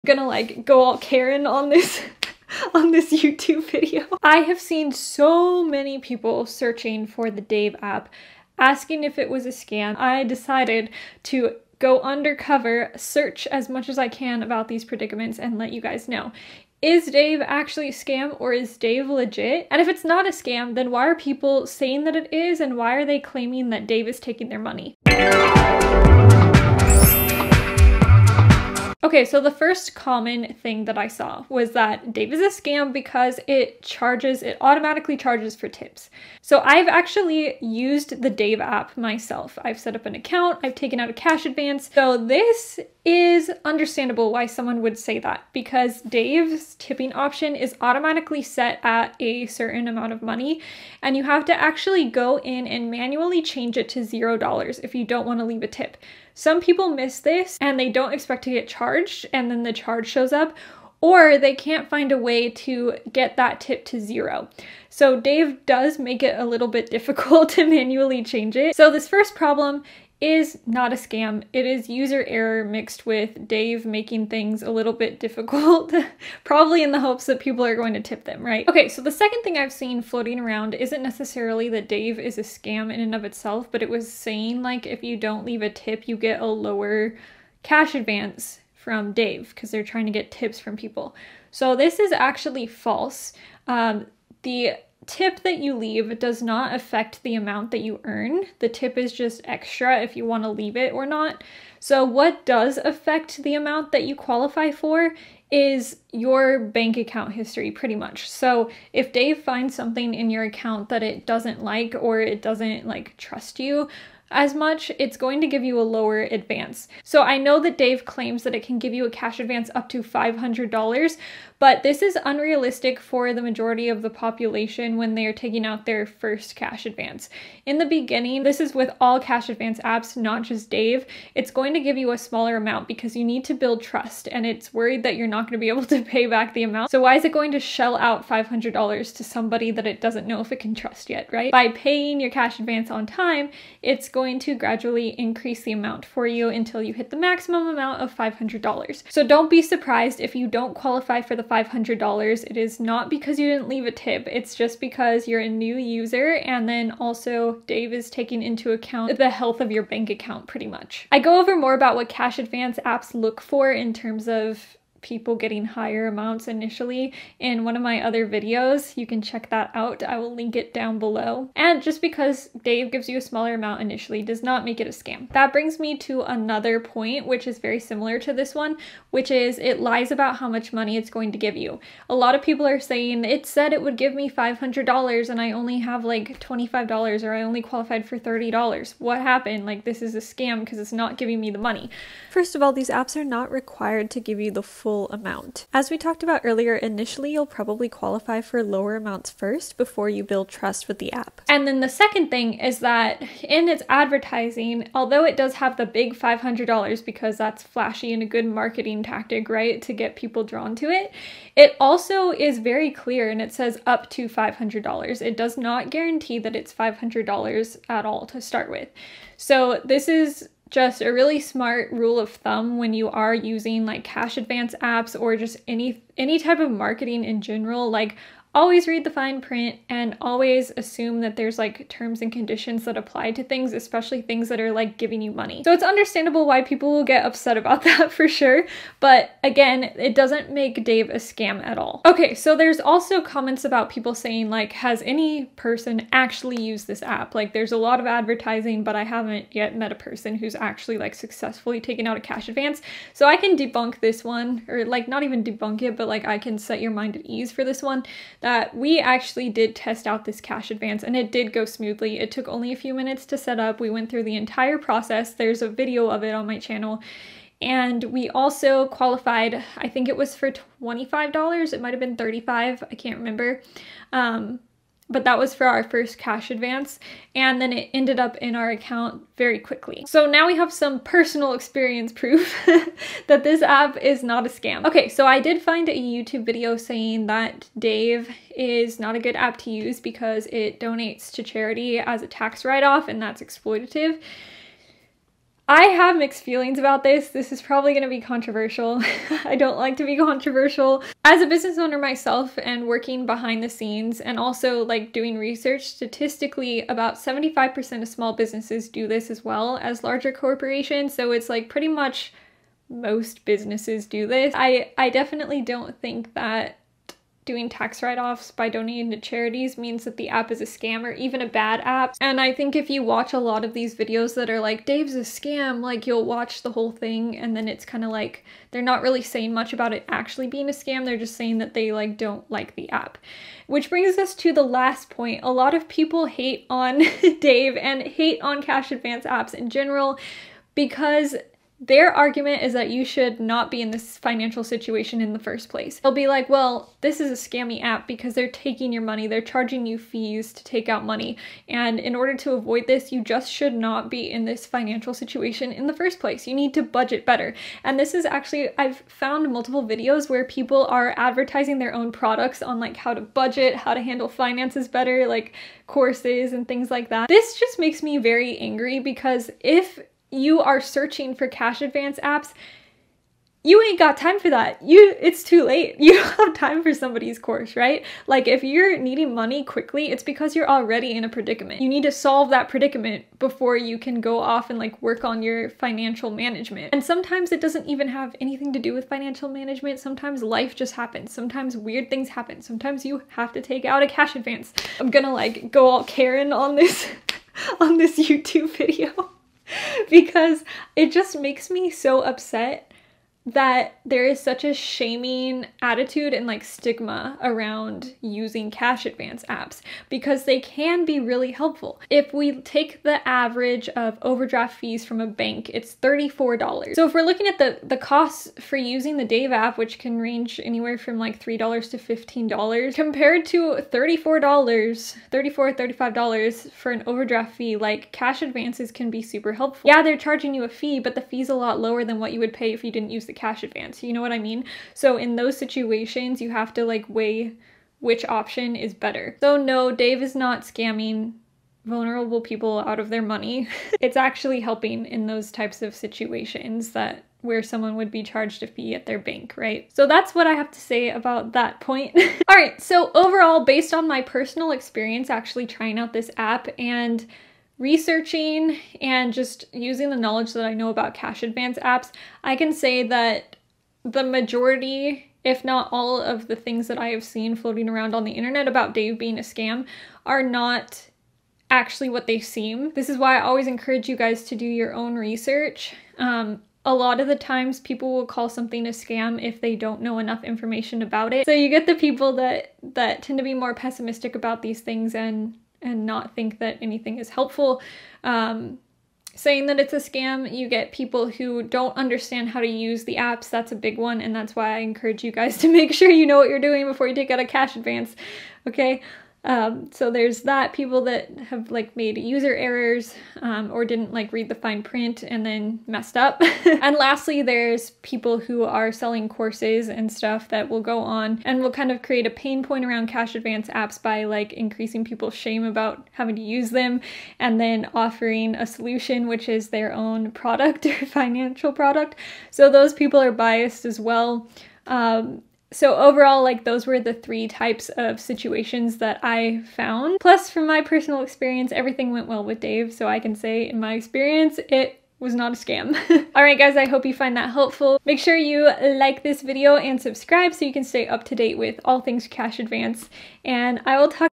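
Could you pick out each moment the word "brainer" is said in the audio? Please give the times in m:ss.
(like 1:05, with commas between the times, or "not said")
not said.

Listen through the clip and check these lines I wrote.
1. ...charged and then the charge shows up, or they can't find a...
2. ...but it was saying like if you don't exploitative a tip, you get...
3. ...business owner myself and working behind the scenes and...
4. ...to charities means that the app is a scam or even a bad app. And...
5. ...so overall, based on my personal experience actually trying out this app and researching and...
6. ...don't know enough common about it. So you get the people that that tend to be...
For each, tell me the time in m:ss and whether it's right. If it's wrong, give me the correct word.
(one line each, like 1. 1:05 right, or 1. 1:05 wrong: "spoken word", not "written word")
1. 0:58 right
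2. 1:23 wrong: "leave", not "exploitative"
3. 5:01 right
4. 5:19 right
5. 7:32 right
6. 7:59 wrong: "information", not "common".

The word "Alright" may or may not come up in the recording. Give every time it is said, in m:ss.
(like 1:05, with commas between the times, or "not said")
8:56.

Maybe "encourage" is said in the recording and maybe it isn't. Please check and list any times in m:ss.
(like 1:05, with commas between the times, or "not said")
7:53, 8:14.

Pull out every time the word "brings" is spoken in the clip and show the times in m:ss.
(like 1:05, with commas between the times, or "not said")
2:55, 5:33.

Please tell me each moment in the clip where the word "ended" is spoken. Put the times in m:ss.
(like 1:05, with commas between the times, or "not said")
4:37.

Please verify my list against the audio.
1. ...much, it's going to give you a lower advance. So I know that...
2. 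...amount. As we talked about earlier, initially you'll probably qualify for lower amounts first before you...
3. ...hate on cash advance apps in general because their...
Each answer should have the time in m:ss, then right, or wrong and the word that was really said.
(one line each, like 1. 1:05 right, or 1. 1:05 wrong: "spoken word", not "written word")
1. 1:54 right
2. 3:15 right
3. 5:38 right.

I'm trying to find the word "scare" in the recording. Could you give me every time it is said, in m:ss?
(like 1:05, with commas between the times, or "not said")
not said.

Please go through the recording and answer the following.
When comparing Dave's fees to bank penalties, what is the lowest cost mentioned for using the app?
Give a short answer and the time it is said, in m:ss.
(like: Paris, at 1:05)
$3, at 7:01.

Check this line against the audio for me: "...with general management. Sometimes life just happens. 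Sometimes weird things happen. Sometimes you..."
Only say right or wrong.
wrong.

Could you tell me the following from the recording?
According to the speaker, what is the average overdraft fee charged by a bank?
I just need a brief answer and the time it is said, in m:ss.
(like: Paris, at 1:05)
$34, at 6:55.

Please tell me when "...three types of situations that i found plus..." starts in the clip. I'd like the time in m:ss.
8:47.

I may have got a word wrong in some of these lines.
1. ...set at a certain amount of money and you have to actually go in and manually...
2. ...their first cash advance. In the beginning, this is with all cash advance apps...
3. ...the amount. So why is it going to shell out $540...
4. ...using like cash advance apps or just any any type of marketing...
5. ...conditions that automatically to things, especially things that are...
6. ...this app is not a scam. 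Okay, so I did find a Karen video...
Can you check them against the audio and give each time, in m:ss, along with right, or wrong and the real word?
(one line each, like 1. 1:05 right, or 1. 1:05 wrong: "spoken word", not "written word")
1. 0:48 right
2. 2:05 right
3. 2:16 wrong: "500", not "540"
4. 3:43 right
5. 3:52 wrong: "apply", not "automatically"
6. 4:43 wrong: "YouTube", not "Karen".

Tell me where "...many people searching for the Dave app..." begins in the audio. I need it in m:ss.
0:05.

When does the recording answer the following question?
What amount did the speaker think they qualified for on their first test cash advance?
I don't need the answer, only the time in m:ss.
4:29.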